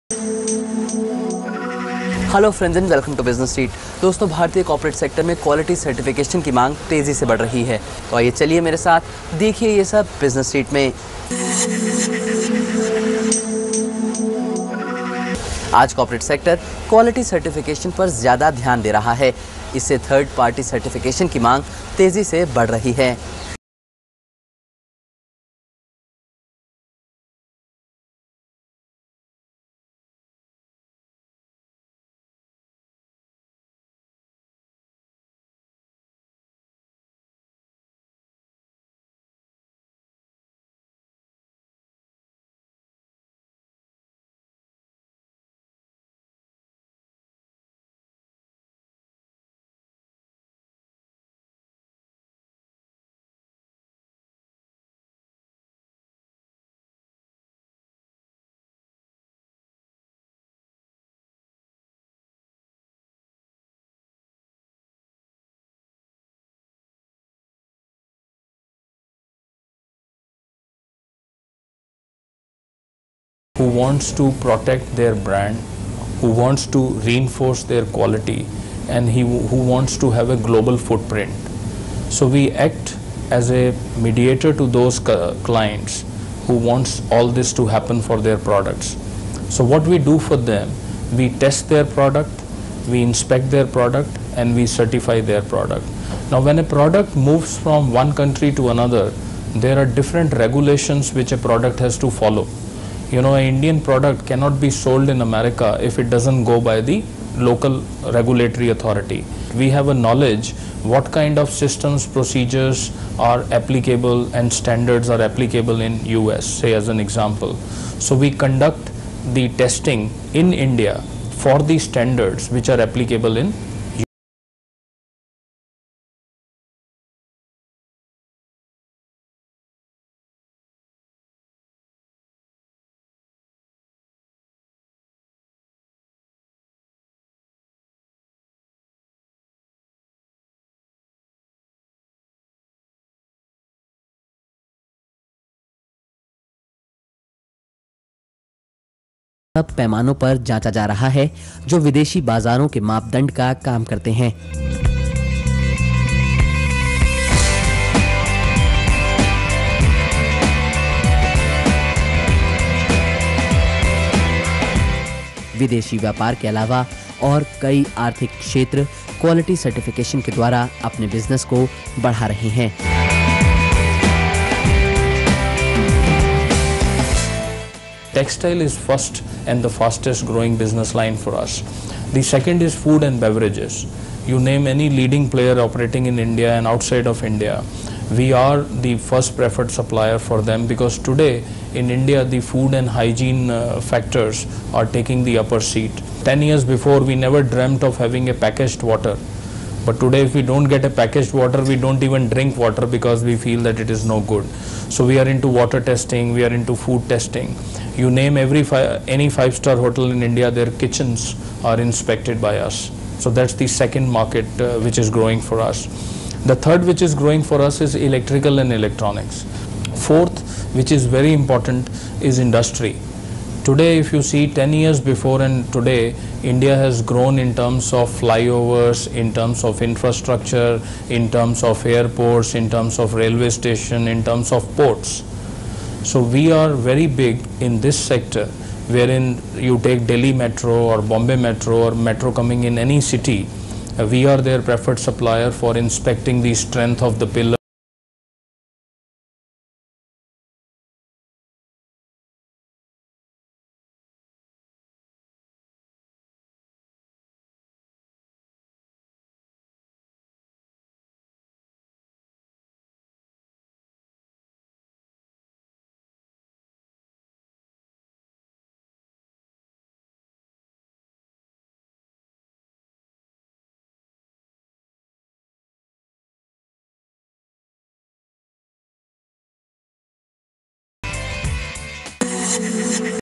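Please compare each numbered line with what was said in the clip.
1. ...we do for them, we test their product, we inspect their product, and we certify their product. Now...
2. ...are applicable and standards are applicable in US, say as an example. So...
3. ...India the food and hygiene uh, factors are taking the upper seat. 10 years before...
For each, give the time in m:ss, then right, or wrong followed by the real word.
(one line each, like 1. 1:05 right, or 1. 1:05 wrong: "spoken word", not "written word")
1. 1:29 right
2. 1:53 right
3. 3:11 right.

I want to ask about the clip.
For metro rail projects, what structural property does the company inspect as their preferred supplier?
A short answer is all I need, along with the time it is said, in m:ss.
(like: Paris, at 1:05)
Strength of the pillar, at 4:06.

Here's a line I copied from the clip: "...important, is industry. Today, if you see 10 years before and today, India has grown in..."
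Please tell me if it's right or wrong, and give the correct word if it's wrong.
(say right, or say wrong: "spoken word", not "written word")
right.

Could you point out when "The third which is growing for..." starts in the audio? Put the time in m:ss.
3:36.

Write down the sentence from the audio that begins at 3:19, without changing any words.
But today if we don't get a packaged water, we don't even drink water because we feel that it is no good.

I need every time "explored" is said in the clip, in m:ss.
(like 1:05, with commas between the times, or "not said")
not said.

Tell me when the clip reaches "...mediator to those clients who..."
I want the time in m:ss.
1:24.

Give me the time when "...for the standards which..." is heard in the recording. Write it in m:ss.
2:01.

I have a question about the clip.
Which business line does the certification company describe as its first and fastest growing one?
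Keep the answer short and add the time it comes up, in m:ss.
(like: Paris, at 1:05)
Textile, at 2:58.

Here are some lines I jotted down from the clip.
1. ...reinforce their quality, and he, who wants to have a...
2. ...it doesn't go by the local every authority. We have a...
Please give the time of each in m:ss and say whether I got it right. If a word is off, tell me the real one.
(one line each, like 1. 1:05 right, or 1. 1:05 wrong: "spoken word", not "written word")
1. 1:17 right
2. 1:45 wrong: "regulatory", not "every".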